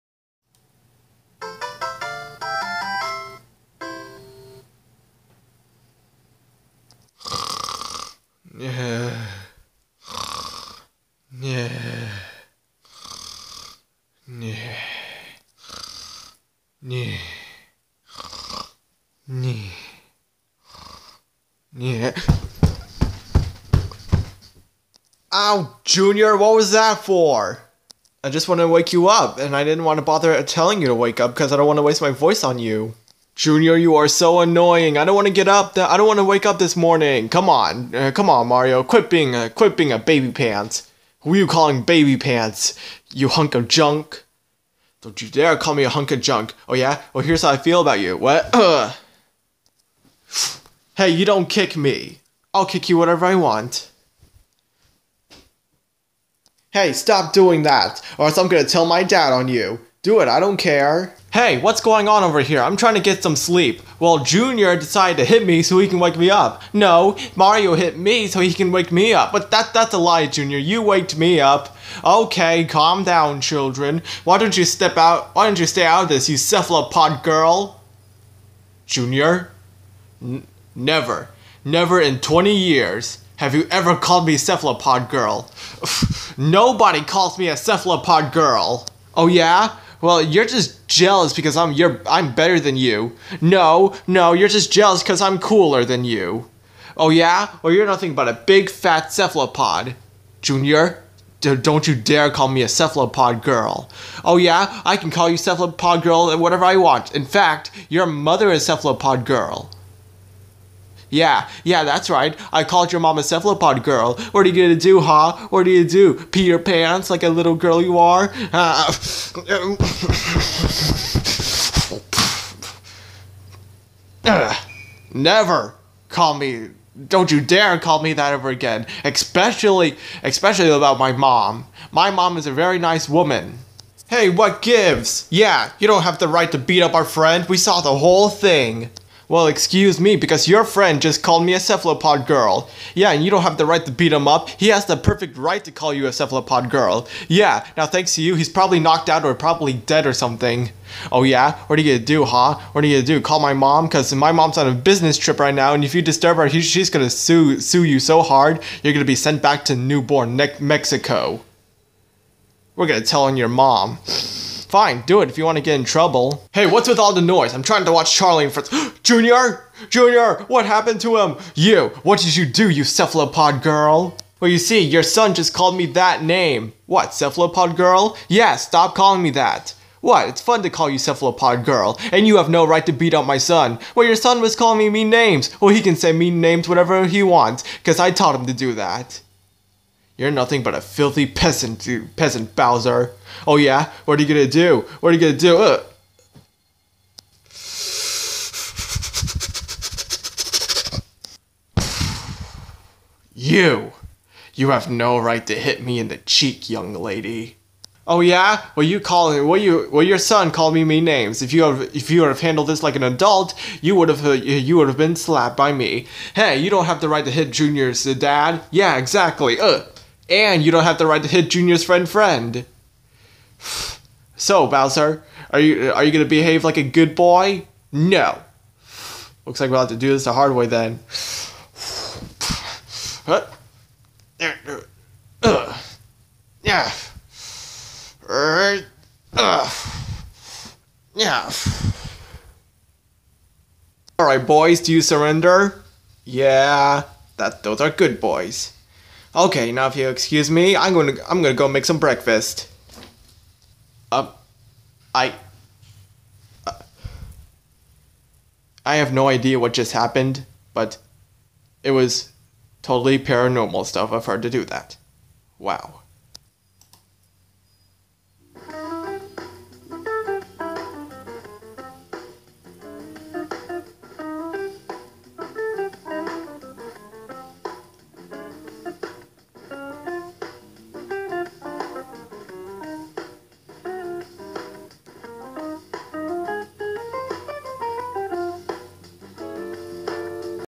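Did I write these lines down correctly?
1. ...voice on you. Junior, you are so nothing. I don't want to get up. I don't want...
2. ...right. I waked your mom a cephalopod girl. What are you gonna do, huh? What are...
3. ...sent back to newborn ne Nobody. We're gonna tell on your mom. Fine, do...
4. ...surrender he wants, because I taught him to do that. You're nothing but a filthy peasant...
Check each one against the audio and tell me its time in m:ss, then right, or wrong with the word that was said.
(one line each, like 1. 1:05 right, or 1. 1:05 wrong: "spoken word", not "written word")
1. 0:32 wrong: "annoying", not "nothing"
2. 1:52 wrong: "called", not "waked"
3. 2:39 wrong: "Mexico", not "Nobody"
4. 3:06 wrong: "whatever", not "surrender".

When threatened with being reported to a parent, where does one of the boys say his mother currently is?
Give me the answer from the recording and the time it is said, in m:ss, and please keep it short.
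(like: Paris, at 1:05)
On a business trip, at 2:34.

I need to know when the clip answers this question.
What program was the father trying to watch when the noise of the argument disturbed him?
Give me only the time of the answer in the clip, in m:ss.
2:48.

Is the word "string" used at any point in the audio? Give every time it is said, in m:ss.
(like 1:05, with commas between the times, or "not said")
not said.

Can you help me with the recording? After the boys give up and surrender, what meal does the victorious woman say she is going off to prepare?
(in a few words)
Breakfast.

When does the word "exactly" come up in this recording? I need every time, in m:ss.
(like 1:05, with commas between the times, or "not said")
3:38.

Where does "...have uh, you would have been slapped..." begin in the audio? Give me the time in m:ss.
3:34.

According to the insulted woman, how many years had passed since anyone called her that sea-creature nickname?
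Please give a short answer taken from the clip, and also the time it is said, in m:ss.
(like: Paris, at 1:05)
20, at 1:22.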